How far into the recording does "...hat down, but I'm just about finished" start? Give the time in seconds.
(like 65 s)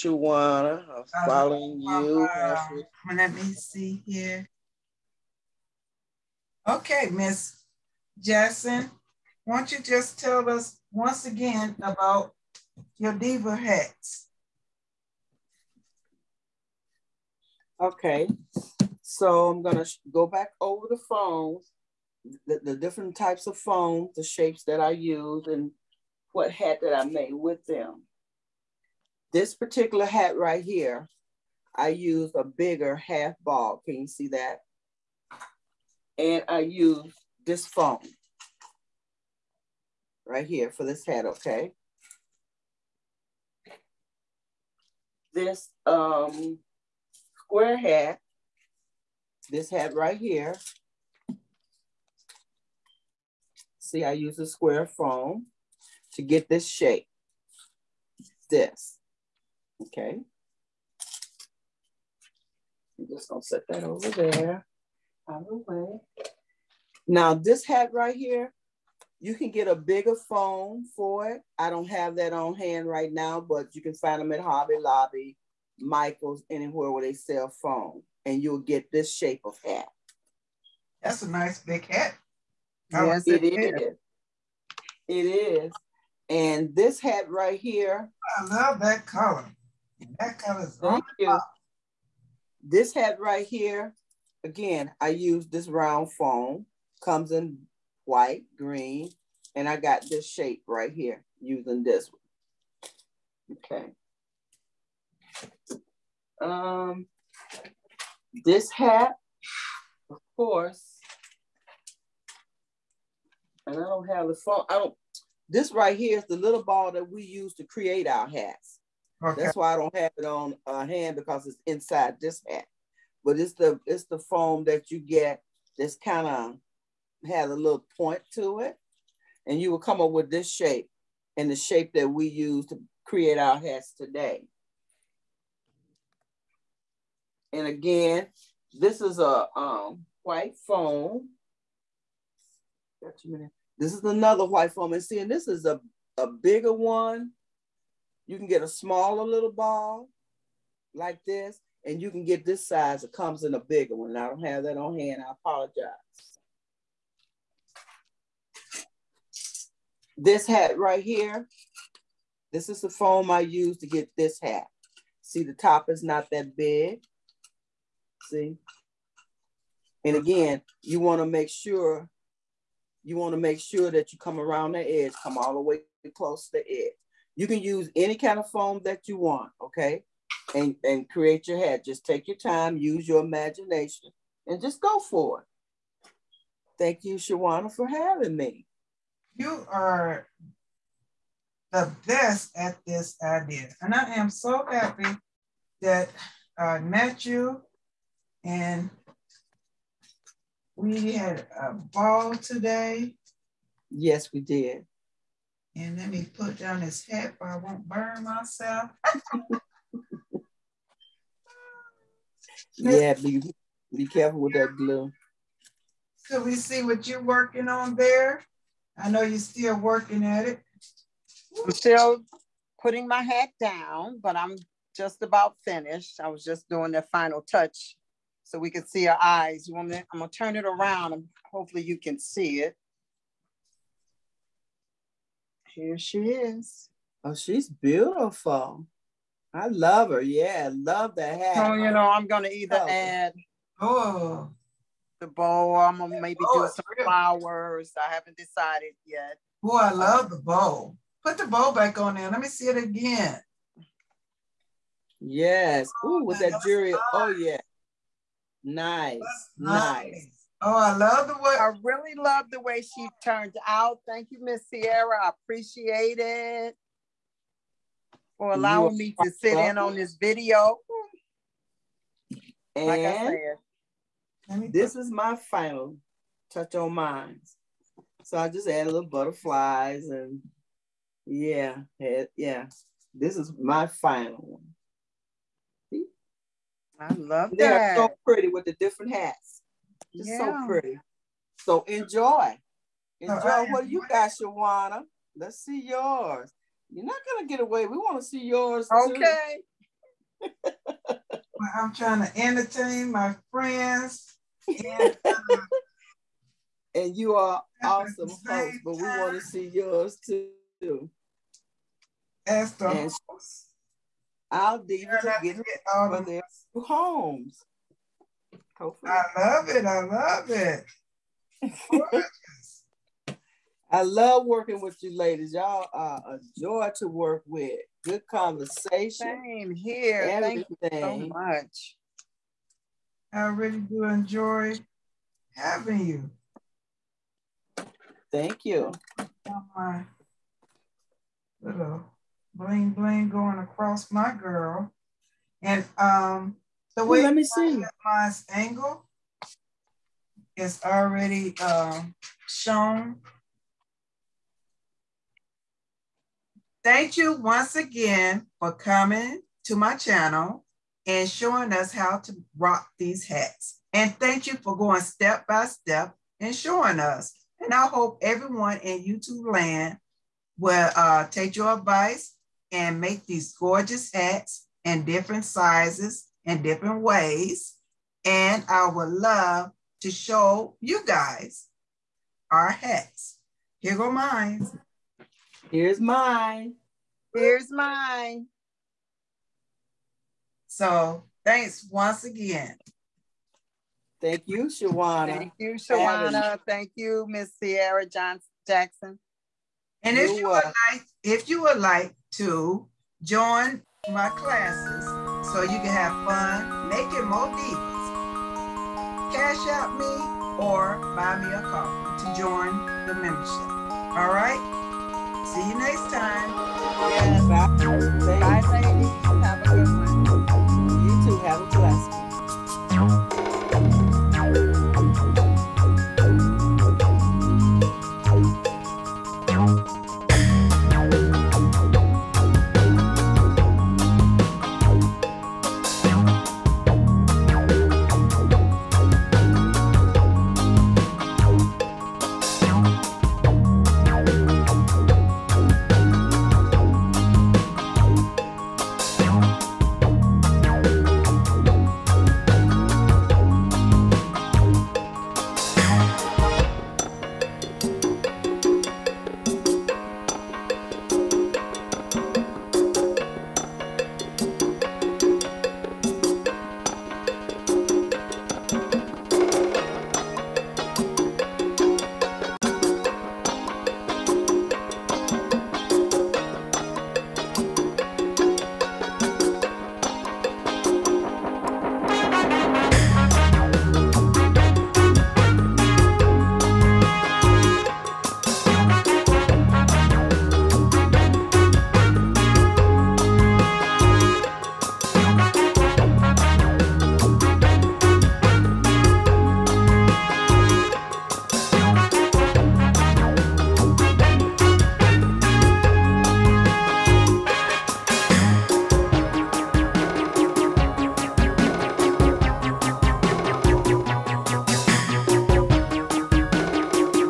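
223 s.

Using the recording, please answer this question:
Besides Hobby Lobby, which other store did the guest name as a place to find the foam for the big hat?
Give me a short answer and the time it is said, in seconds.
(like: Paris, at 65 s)
Michaels, at 75 s.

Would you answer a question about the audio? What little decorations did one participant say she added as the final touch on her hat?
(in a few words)
butterflies.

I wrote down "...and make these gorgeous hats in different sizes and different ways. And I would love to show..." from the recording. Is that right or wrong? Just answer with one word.
right.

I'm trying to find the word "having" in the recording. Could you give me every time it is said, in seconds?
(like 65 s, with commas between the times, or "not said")
187 s, 335 s.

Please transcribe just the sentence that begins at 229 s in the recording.
I'm gonna turn it around and hopefully you can see it.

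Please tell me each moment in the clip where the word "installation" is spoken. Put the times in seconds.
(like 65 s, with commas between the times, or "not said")
not said.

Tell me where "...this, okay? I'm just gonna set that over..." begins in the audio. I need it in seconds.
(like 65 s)
58 s.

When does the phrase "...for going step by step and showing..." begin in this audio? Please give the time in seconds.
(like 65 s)
364 s.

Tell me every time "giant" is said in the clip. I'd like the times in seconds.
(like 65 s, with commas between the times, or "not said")
not said.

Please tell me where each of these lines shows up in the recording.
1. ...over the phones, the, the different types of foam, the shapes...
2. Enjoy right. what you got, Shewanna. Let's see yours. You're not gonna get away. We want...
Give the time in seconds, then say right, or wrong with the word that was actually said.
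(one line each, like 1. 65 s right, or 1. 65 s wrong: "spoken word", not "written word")
1. 20 s right
2. 293 s right.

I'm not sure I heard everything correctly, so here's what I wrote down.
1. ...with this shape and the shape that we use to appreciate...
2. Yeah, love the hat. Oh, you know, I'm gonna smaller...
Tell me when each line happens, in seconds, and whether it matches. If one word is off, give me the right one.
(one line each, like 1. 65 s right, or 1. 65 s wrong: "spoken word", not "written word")
1. 130 s wrong: "create", not "appreciate"
2. 240 s wrong: "either", not "smaller".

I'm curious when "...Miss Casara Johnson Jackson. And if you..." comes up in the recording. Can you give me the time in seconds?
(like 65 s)
397 s.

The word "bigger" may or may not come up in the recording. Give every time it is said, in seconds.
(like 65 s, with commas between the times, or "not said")
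32 s, 69 s, 146 s, 153 s.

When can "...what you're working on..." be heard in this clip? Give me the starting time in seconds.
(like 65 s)
216 s.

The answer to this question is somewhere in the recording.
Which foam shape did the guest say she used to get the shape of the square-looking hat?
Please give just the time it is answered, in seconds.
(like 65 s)
54 s.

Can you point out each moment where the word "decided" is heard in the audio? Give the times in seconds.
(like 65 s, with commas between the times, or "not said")
248 s.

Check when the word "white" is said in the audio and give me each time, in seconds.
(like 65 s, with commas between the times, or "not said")
98 s, 140 s, 144 s.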